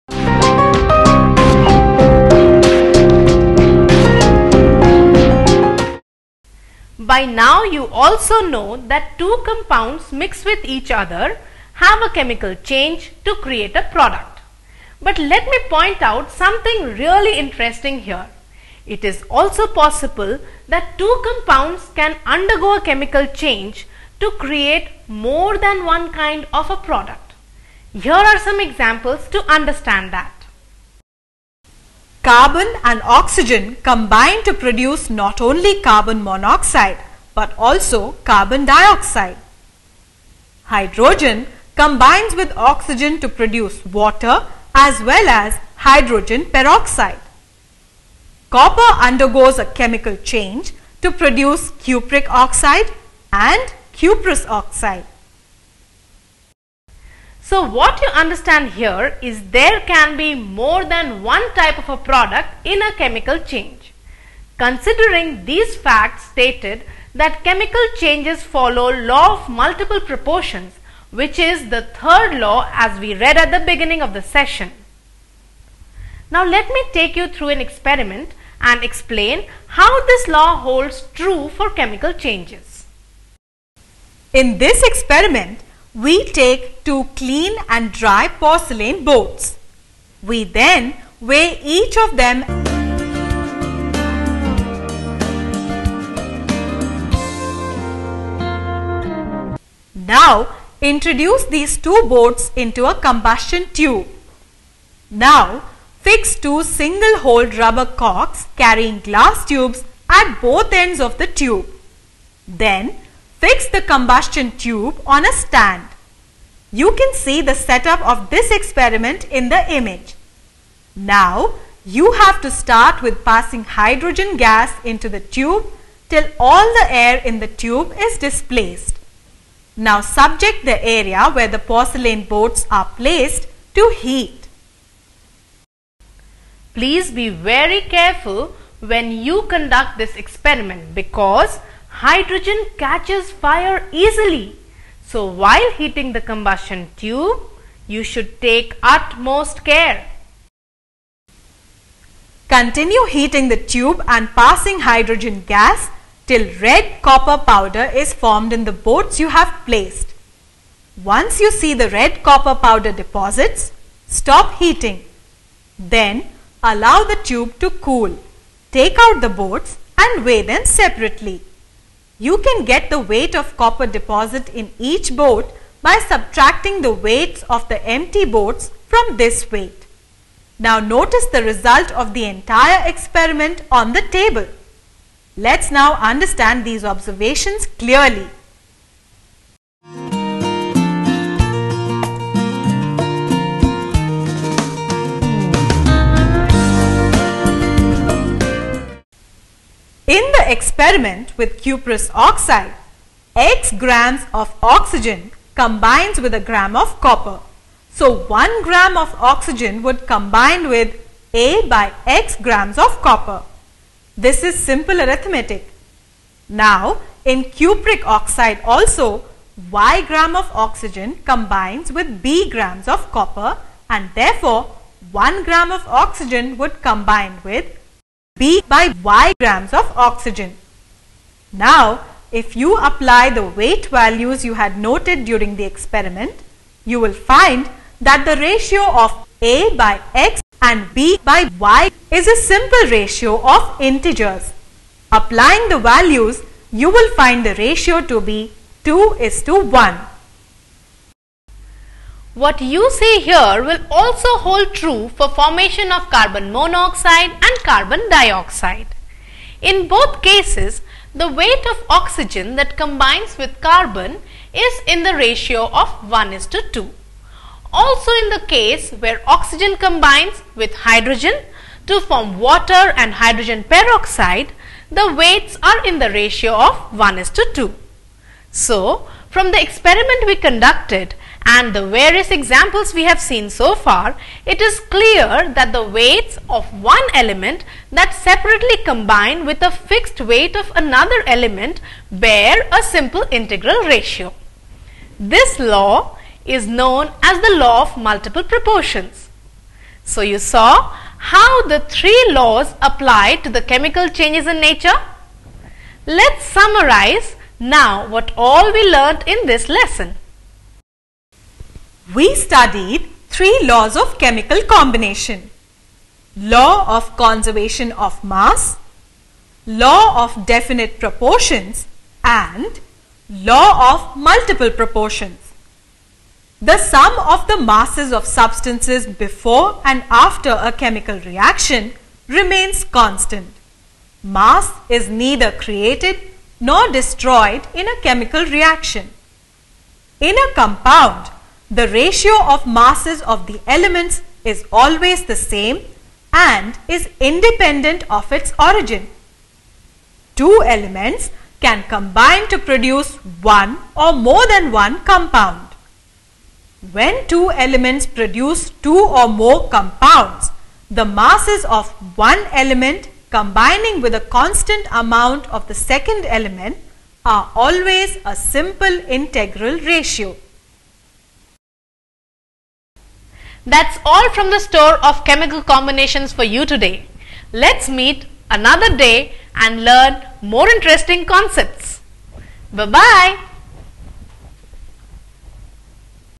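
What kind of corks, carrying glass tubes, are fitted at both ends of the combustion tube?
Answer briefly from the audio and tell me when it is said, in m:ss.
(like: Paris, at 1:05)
single hole rubber corks, at 1:46.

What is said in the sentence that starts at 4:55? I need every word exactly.
This law is known as the law of multiple proportions.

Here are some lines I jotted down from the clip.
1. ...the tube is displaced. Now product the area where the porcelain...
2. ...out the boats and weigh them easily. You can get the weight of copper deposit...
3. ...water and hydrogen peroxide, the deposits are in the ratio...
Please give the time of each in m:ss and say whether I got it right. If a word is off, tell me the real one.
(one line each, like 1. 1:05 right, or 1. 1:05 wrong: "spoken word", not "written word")
1. 2:07 wrong: "subject", not "product"
2. 2:48 wrong: "separately", not "easily"
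3. 4:32 wrong: "weights", not "deposits".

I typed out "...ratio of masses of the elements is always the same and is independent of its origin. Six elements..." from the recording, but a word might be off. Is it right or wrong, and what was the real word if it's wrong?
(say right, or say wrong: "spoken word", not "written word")
wrong: "Two", not "Six".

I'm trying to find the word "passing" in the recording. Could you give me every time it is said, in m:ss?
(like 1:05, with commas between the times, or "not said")
2:03, 2:34.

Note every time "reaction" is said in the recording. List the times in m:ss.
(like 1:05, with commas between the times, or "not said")
5:31, 5:38.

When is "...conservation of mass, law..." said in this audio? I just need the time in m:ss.
5:17.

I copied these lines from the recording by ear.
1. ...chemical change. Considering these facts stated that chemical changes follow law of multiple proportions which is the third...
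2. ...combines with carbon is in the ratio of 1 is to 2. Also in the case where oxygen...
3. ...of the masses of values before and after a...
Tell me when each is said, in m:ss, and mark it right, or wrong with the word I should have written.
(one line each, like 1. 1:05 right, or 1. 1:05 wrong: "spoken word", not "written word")
1. 1:02 right
2. 4:22 right
3. 5:27 wrong: "substances", not "values".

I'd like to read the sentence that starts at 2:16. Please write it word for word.
Please be very careful when you conduct this experiment because Hydrogen catches fire easily.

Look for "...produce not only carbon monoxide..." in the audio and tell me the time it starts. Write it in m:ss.
0:34.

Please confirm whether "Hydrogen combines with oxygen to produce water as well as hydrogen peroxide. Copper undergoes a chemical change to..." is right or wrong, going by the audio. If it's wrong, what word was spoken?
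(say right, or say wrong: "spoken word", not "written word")
right.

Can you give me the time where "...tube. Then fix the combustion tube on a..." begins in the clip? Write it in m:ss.
1:51.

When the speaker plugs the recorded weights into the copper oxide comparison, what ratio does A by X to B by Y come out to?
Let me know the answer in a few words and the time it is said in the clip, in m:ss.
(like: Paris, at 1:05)
2:1, at 4:08.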